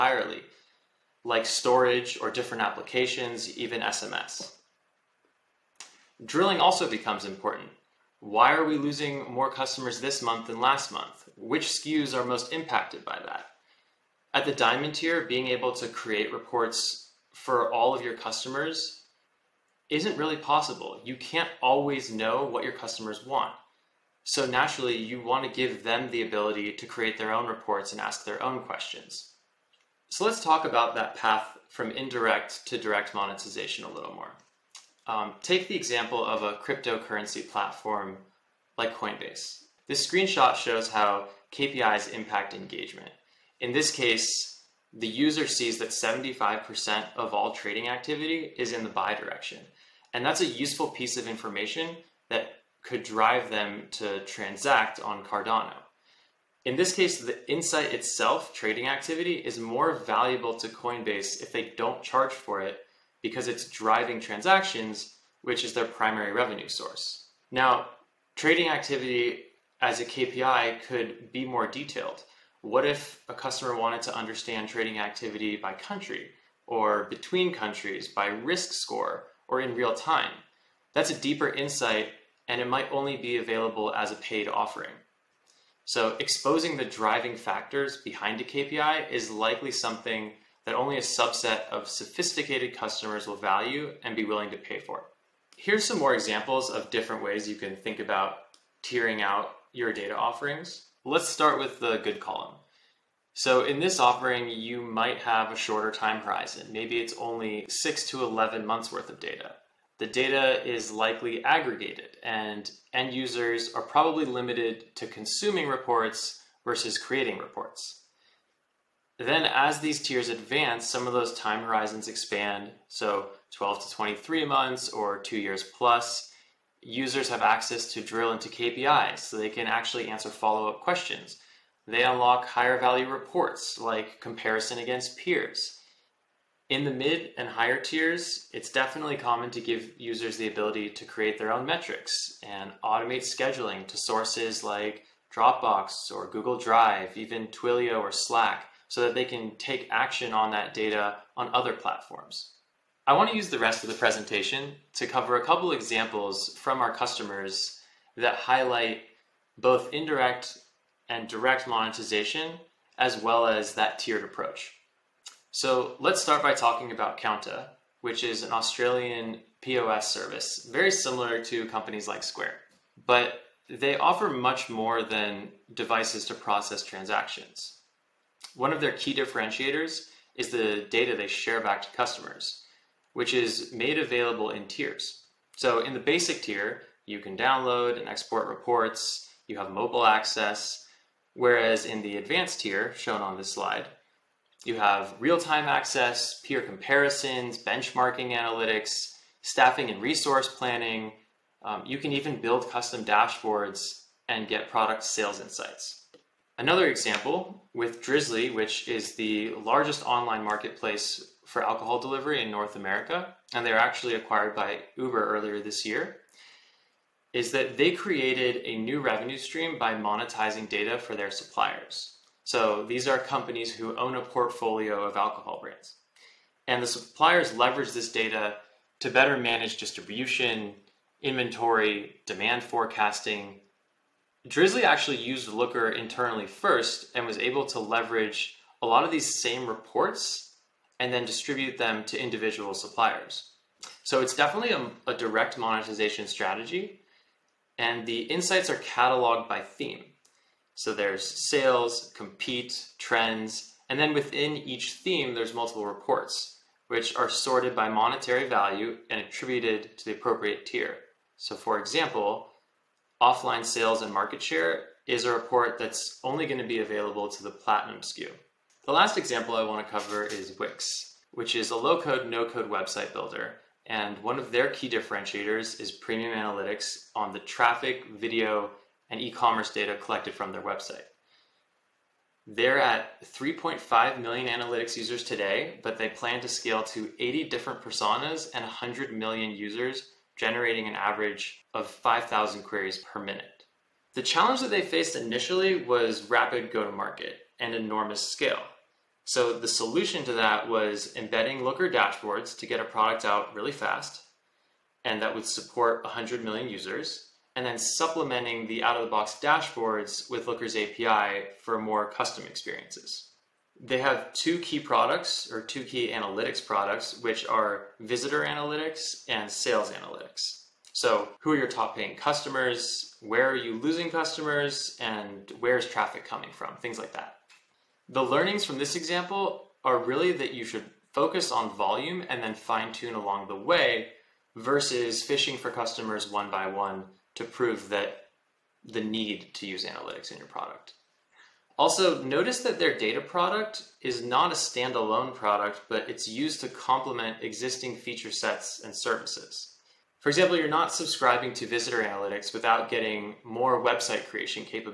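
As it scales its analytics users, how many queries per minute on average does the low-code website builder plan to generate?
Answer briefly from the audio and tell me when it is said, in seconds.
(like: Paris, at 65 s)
5,000, at 291 s.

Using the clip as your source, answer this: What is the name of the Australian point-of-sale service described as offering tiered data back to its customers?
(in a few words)
Kounta.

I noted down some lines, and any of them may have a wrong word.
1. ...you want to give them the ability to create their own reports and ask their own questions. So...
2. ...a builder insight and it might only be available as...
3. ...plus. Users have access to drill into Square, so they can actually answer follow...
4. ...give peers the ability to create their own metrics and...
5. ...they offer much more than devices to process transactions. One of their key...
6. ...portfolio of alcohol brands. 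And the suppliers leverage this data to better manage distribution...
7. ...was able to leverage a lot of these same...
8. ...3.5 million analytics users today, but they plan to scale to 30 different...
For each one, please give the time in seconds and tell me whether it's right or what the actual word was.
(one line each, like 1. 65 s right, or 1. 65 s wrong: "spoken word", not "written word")
1. 24 s right
2. 81 s wrong: "deeper", not "builder"
3. 125 s wrong: "KPIs", not "Square"
4. 139 s wrong: "users", not "peers"
5. 173 s right
6. 224 s right
7. 237 s right
8. 283 s wrong: "80", not "30".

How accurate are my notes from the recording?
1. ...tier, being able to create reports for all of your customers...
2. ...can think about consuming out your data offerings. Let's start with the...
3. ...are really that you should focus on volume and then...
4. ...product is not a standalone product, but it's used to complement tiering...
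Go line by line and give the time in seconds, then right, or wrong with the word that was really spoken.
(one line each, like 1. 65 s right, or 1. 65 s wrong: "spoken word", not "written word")
1. 14 s right
2. 97 s wrong: "tiering", not "consuming"
3. 329 s right
4. 343 s wrong: "existing", not "tiering".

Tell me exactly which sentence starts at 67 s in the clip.
Now, trading activity as a KPI could be more detailed.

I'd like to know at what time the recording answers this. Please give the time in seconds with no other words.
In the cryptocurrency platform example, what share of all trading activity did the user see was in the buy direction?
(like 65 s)
45 s.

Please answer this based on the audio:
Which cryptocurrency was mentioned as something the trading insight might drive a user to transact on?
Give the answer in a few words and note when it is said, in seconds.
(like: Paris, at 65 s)
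Cardano, at 55 s.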